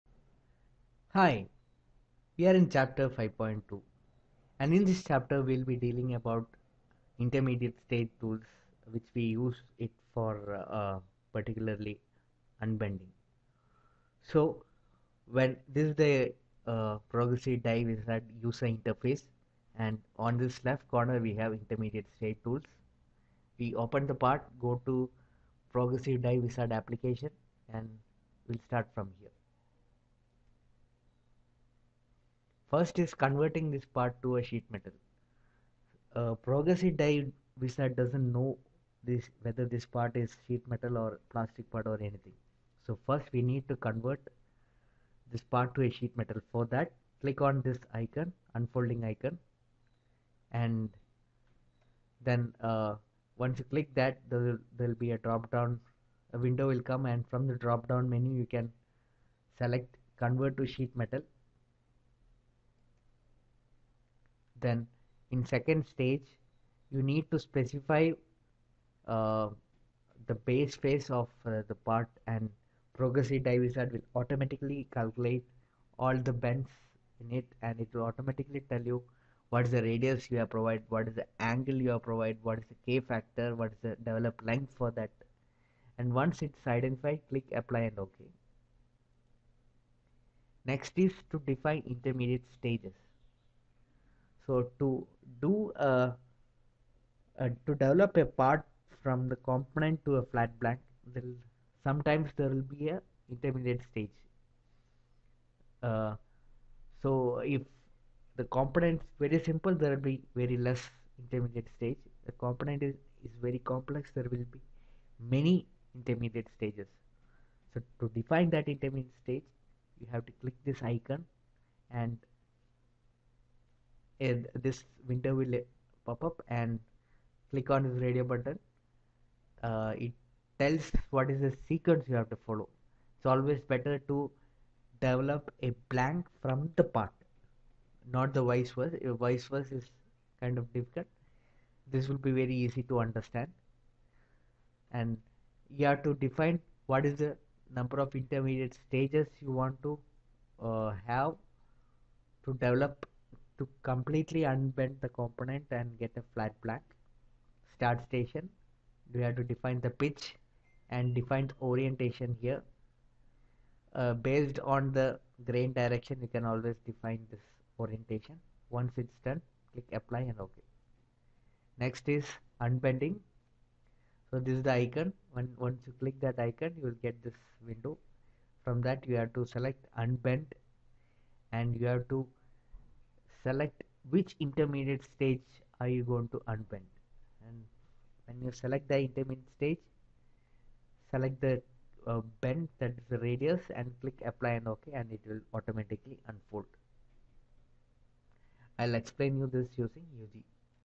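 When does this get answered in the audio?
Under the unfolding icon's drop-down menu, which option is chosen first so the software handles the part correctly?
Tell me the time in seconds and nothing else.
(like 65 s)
60 s.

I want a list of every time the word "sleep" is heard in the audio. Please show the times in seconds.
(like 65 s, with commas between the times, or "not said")
not said.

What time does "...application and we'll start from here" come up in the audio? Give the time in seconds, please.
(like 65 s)
26 s.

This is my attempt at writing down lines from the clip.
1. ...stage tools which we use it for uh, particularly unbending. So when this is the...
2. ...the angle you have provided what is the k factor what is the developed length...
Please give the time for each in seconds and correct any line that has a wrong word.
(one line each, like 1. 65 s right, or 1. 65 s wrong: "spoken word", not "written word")
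1. 7 s right
2. 81 s right.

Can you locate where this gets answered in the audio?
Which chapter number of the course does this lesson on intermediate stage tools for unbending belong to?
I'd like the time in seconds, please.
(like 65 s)
2 s.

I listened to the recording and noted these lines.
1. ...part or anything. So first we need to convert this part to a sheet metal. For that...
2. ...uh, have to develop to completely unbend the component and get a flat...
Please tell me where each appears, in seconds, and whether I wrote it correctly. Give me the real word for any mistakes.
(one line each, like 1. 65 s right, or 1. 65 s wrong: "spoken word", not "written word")
1. 41 s right
2. 150 s right.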